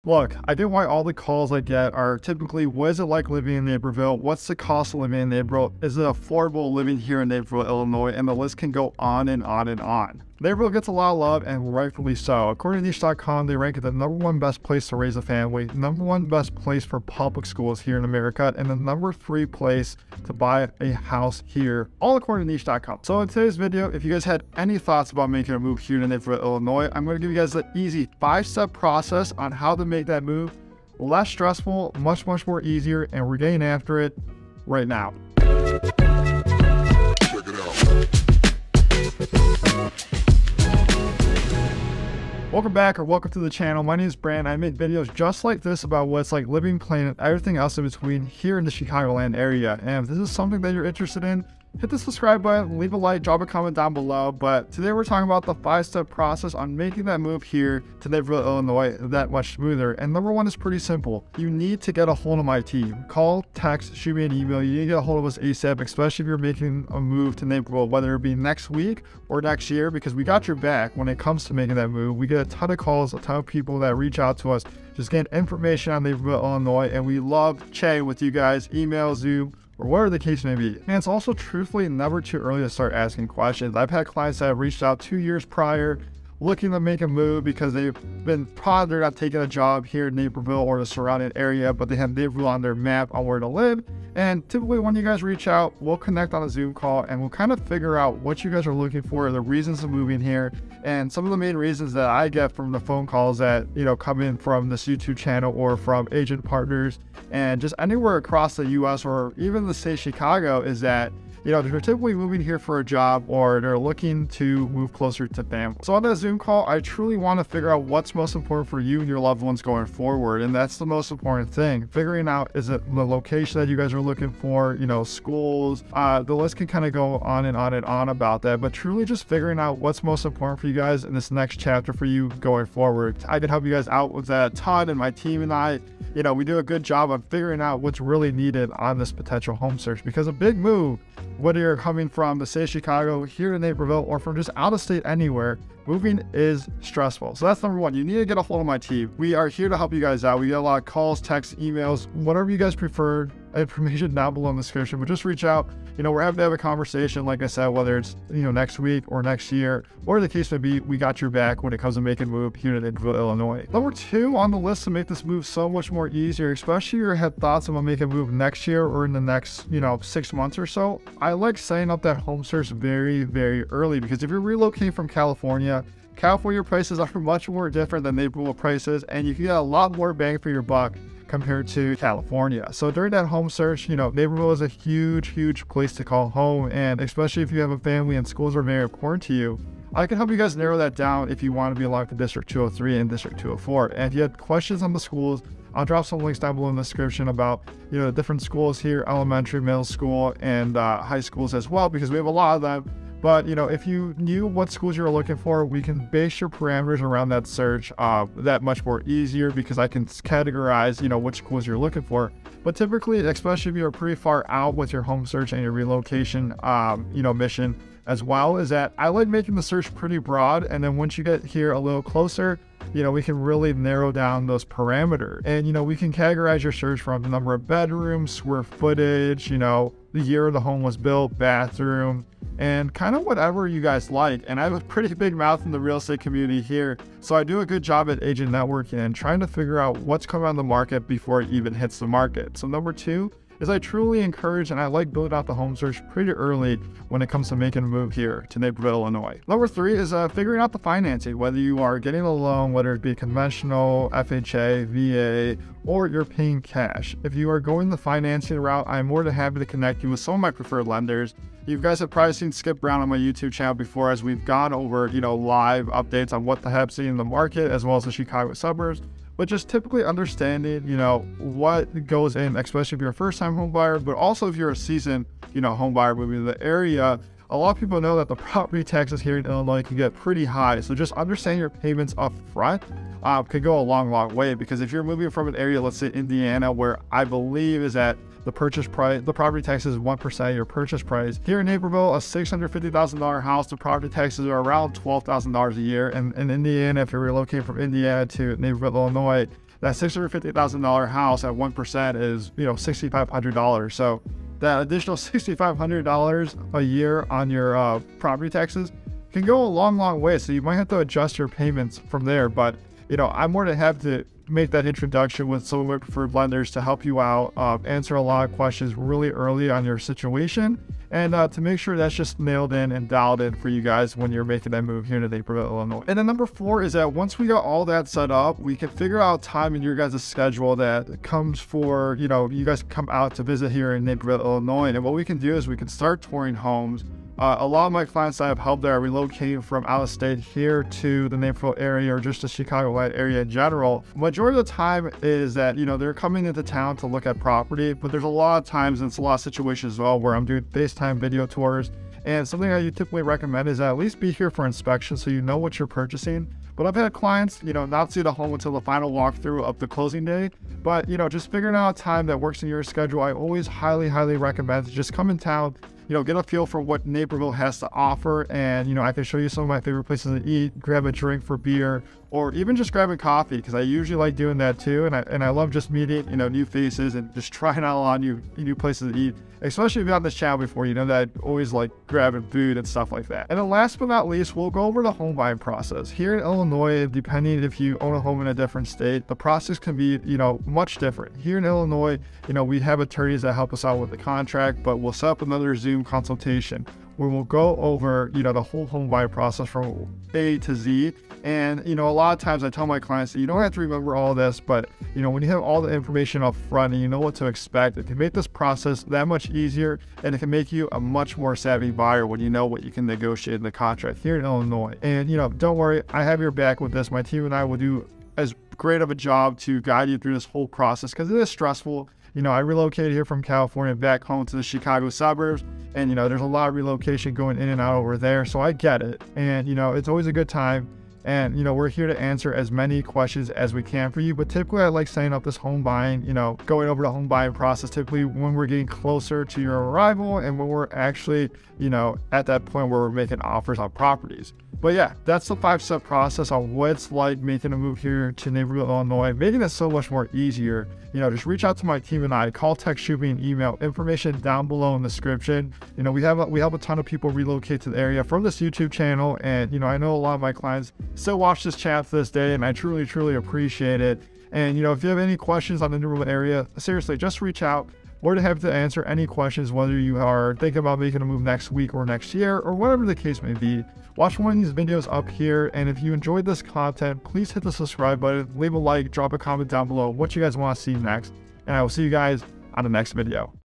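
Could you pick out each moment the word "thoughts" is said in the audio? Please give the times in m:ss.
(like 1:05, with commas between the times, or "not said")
0:24, 2:47.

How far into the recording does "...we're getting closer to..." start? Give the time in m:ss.
7:18.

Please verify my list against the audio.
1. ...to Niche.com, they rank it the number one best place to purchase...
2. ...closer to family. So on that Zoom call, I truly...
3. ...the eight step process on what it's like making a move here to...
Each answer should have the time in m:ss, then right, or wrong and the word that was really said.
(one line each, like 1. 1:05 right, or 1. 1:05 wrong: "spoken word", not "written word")
1. 0:12 wrong: "raise", not "purchase"
2. 1:54 right
3. 7:25 wrong: "five", not "eight".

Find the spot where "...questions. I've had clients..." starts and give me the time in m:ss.
1:23.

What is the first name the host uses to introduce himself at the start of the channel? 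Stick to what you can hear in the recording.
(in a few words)
Brand.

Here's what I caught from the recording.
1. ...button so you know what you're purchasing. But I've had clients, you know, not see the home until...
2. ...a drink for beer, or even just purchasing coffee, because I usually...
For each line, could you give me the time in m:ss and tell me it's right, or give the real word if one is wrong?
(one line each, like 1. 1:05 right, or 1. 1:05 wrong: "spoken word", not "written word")
1. 5:54 wrong: "inspection", not "button"
2. 6:11 wrong: "grabbing", not "purchasing".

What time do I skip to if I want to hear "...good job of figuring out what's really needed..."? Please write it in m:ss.
2:16.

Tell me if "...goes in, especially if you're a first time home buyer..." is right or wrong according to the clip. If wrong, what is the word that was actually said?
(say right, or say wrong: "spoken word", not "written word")
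right.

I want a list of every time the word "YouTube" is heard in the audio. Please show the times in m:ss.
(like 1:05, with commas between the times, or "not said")
1:44, 4:23, 7:38.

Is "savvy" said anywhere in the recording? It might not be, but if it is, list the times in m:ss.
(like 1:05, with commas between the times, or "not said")
6:51.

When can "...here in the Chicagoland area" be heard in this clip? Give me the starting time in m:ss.
0:48.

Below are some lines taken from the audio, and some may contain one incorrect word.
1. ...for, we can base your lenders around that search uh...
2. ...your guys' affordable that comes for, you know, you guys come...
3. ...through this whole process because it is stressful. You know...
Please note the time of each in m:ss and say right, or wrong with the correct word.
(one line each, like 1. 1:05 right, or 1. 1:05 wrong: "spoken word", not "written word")
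1. 3:25 wrong: "parameters", not "lenders"
2. 5:29 wrong: "schedule", not "affordable"
3. 7:00 right.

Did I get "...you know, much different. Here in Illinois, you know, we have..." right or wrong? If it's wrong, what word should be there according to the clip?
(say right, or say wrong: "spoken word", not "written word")
right.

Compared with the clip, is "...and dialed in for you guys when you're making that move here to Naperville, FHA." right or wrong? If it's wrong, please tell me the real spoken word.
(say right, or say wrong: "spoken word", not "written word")
wrong: "Illinois", not "FHA".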